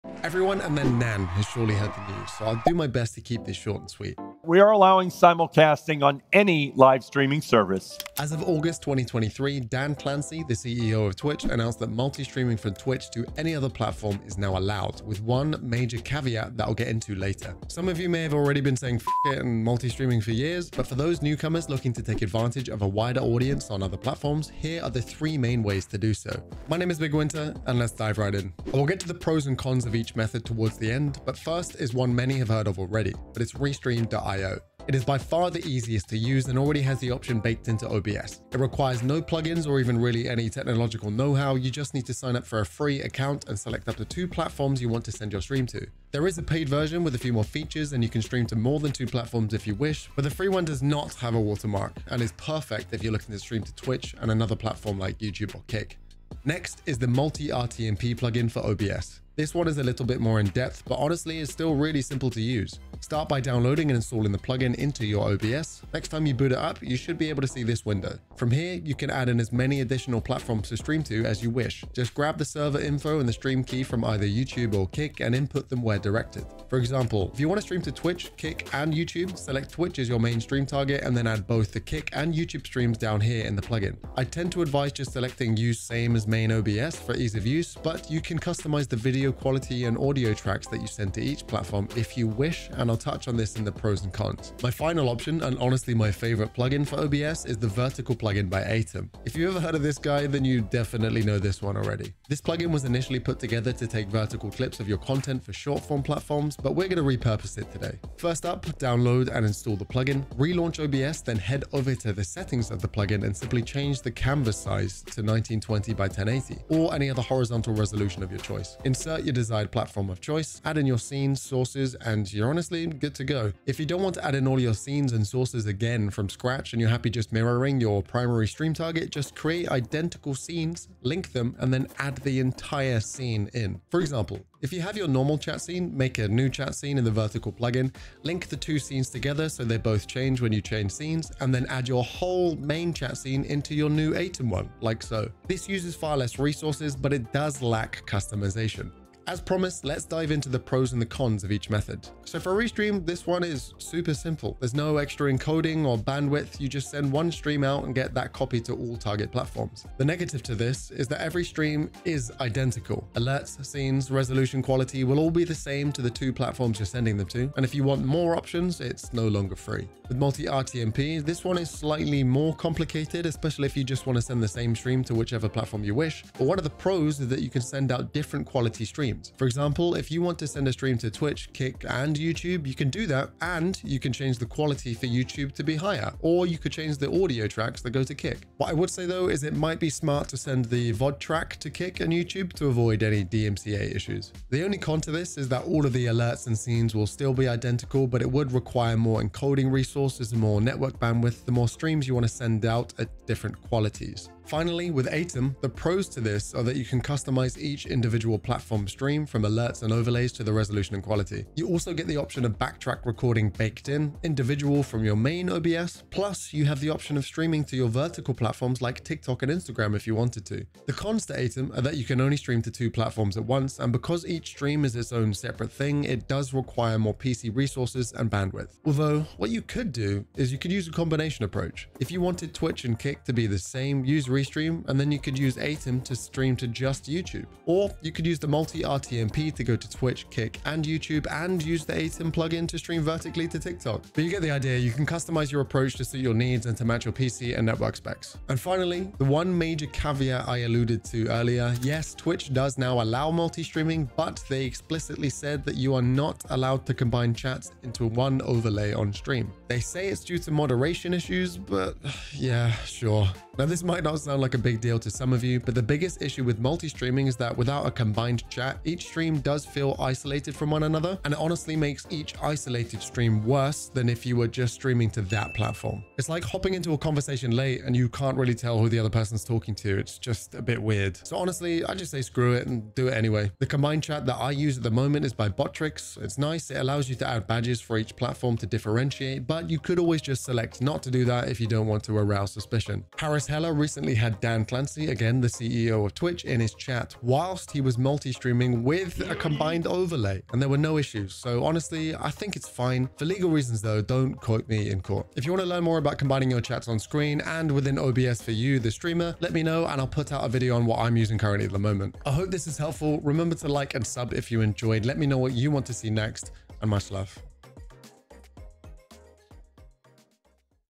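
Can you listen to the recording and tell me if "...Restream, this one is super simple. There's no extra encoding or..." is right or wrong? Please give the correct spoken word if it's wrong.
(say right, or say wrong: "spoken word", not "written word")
right.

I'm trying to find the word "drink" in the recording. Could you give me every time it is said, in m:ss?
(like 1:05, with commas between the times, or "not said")
not said.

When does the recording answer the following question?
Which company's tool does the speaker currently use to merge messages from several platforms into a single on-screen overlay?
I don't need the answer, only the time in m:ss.
4:45.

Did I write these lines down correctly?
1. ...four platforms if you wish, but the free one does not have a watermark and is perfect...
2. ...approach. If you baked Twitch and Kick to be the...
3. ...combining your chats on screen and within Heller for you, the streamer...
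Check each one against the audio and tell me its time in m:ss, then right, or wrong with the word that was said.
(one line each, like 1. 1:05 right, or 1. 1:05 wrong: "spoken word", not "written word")
1. 0:48 wrong: "two", not "four"
2. 3:51 wrong: "wanted", not "baked"
3. 5:06 wrong: "OBS", not "Heller".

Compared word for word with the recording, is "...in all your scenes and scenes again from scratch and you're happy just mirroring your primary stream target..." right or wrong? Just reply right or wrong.
wrong.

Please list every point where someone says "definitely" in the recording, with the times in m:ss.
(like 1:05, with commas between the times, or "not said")
1:40.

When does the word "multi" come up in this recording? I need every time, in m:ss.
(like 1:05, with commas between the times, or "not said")
0:11, 0:19, 0:57, 2:50, 3:58, 4:13, 4:26, 4:57.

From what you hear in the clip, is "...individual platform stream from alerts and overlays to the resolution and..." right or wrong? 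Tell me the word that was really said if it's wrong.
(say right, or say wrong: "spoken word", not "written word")
right.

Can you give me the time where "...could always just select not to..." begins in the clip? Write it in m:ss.
4:49.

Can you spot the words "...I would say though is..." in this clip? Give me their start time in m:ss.
3:08.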